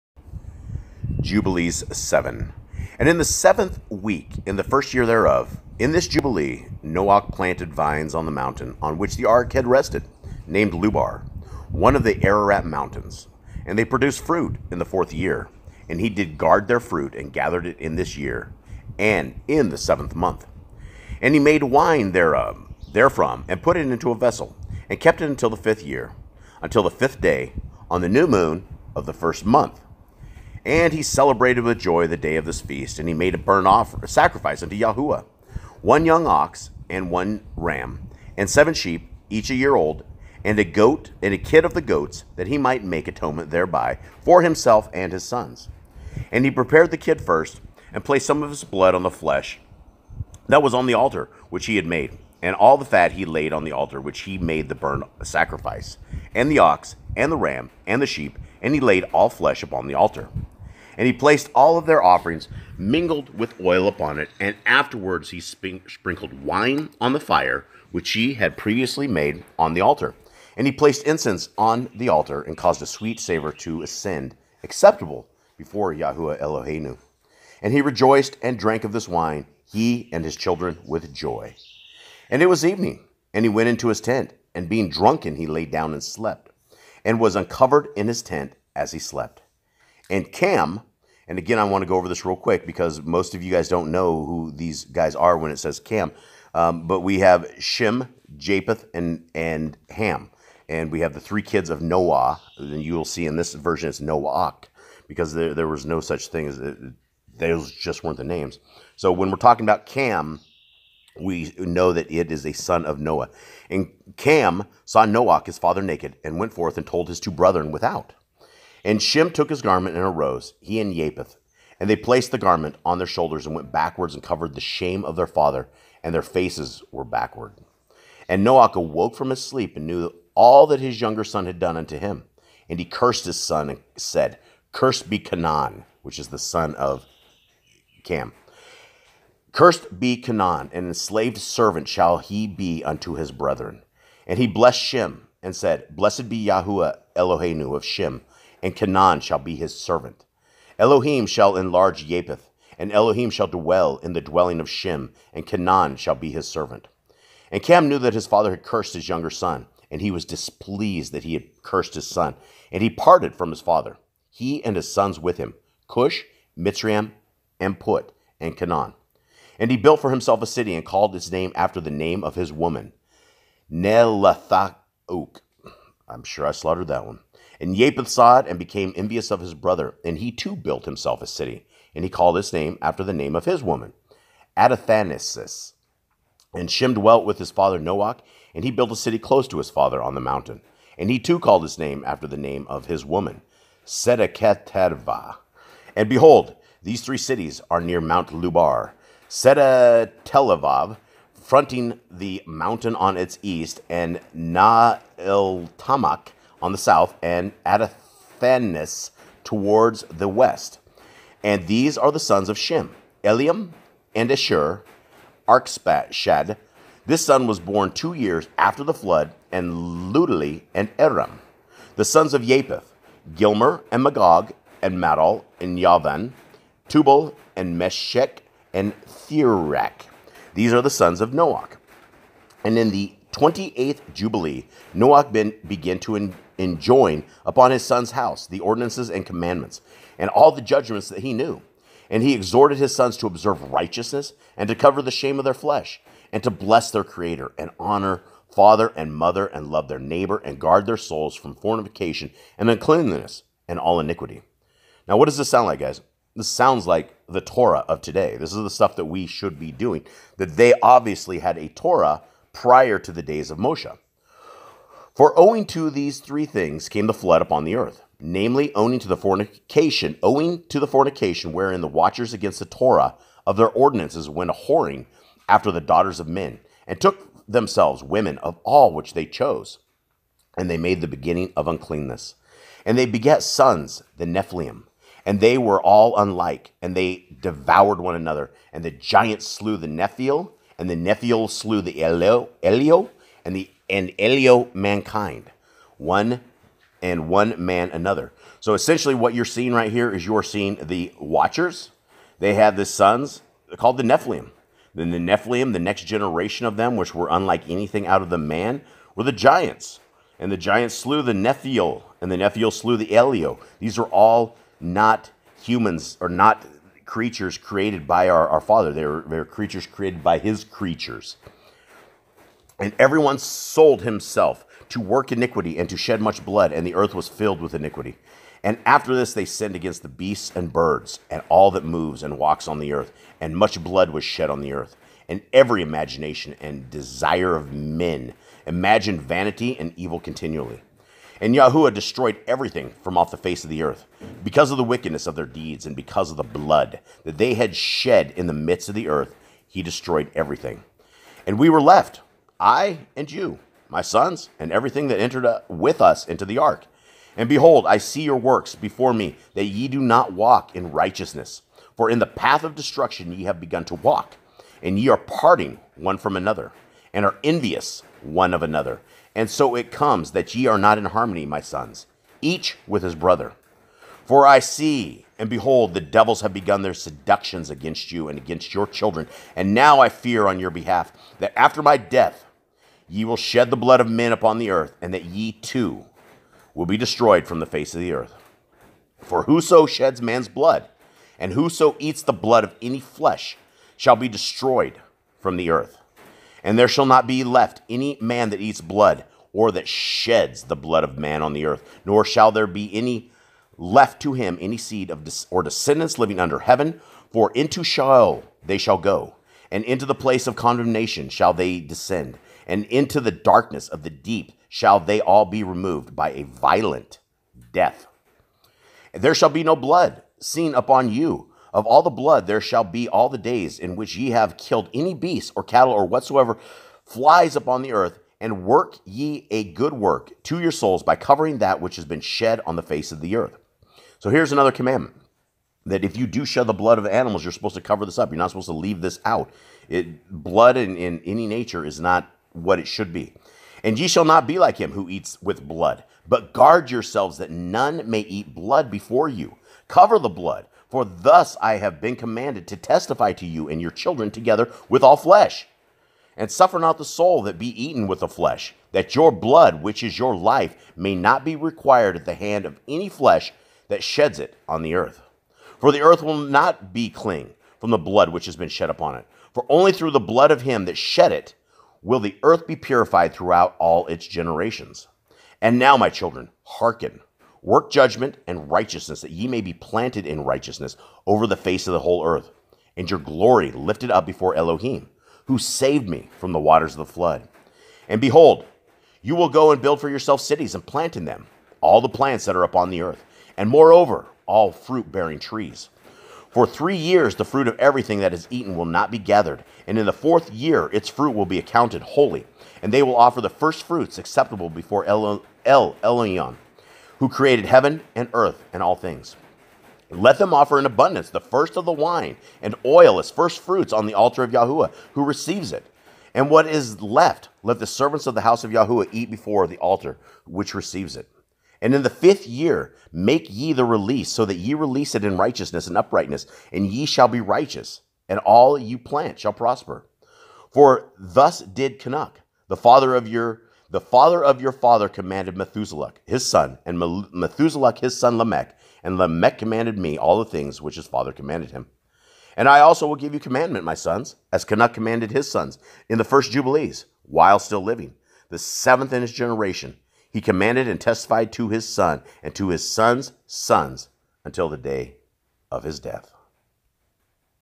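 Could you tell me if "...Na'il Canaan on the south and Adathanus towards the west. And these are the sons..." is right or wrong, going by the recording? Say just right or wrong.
wrong.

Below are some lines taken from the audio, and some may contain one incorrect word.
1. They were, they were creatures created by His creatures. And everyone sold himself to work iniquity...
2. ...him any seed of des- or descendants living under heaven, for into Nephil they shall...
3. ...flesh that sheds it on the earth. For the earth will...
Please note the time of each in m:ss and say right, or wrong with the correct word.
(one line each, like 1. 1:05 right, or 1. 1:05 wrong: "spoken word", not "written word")
1. 5:18 right
2. 6:44 wrong: "Sheol", not "Nephil"
3. 7:43 right.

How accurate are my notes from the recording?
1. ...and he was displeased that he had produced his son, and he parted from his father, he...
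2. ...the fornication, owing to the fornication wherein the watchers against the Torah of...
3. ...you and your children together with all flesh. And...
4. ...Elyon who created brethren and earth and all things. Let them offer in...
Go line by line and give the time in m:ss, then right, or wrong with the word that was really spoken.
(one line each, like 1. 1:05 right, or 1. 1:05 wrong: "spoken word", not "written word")
1. 2:39 wrong: "cursed", not "produced"
2. 4:29 right
3. 7:33 right
4. 8:26 wrong: "heaven", not "brethren".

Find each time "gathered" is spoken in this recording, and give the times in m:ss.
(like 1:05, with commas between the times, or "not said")
0:17, 8:19.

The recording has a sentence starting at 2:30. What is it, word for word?
Elohim shall enlarge Japheth, and Elohim shall dwell in the dwelling of Shem, and Canaan shall be his servant.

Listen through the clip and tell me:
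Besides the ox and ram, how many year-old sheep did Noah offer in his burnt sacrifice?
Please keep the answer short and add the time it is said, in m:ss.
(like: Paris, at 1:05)
7, at 0:38.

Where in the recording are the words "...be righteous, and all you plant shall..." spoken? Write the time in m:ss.
8:47.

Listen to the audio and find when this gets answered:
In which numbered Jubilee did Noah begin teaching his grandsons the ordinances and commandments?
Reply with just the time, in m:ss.
3:53.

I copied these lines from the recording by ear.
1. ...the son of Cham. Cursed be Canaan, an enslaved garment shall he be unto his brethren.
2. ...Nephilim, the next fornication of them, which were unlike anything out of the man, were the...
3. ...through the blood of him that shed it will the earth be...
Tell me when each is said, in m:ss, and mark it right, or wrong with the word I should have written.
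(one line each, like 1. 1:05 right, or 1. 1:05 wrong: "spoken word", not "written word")
1. 2:16 wrong: "servant", not "garment"
2. 5:05 wrong: "generation", not "fornication"
3. 7:49 right.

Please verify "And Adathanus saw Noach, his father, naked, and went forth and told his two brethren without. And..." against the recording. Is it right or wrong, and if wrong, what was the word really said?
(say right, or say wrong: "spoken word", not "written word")
wrong: "Cham", not "Adathanus".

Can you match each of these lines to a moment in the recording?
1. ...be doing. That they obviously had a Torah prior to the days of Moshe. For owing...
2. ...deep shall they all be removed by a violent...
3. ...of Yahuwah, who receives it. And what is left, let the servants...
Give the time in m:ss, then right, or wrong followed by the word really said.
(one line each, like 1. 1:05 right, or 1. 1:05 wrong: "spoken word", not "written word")
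1. 4:19 right
2. 6:54 right
3. 8:34 right.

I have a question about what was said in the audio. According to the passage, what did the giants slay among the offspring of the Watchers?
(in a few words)
the Nephil.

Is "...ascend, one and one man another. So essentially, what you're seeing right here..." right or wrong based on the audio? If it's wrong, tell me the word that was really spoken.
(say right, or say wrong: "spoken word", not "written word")
wrong: "mankind", not "ascend".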